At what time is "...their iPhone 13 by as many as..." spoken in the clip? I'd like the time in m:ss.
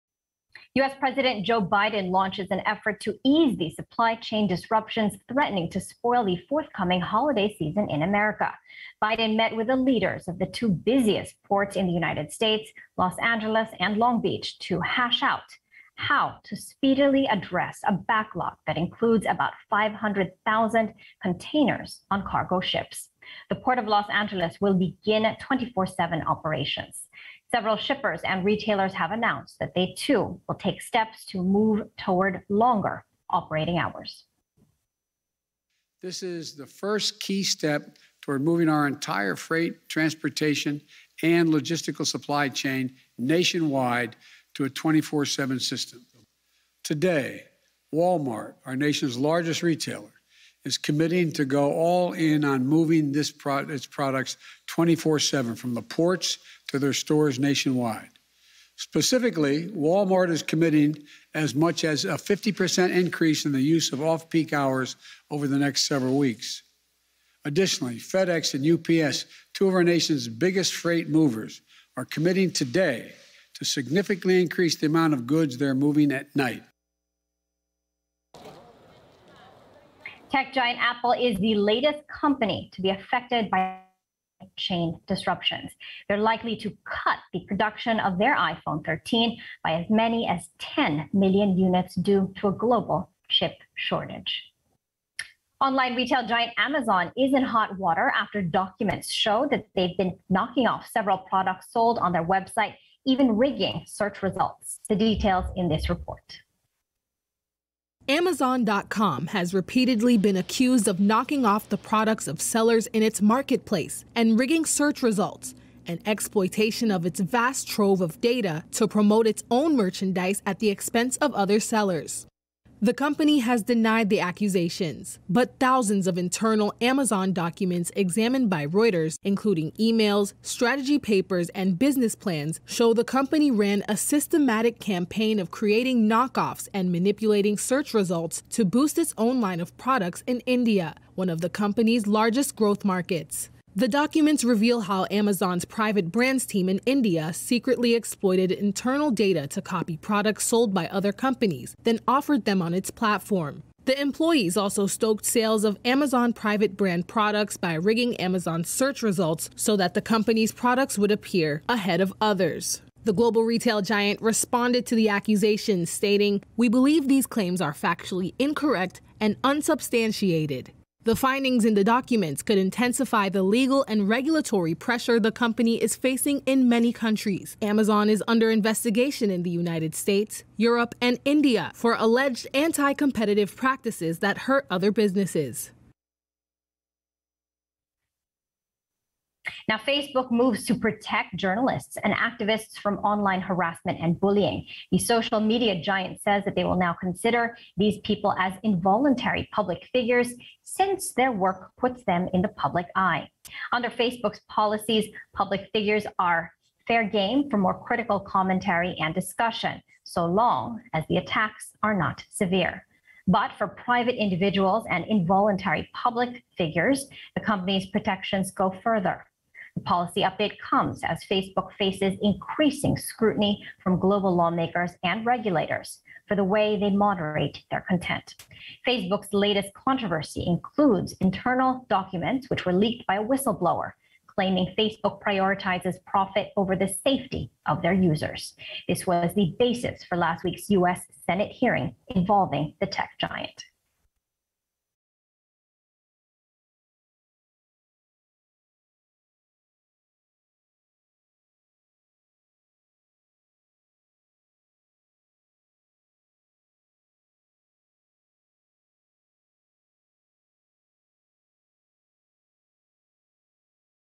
1:28.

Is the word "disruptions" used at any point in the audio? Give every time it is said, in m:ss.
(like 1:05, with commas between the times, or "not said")
0:04, 1:25.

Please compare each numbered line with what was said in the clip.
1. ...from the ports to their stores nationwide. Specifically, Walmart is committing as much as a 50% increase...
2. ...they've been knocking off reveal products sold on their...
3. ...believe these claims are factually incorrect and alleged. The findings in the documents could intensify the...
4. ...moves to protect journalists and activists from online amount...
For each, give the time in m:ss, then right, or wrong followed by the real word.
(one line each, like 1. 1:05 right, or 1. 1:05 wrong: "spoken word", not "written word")
1. 0:55 right
2. 1:39 wrong: "several", not "reveal"
3. 2:46 wrong: "unsubstantiated", not "alleged"
4. 3:10 wrong: "harassment", not "amount".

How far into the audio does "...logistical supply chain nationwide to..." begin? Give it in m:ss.
0:41.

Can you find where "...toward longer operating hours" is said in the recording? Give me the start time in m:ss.
0:31.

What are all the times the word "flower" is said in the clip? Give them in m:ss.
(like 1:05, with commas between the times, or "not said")
not said.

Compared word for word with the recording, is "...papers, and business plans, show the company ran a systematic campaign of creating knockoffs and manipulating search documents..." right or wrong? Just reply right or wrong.
wrong.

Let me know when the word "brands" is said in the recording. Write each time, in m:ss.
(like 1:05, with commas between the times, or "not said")
2:26, 2:36.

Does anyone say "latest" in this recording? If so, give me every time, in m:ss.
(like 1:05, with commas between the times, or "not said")
1:21, 3:49.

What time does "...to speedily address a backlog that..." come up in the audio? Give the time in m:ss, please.
0:16.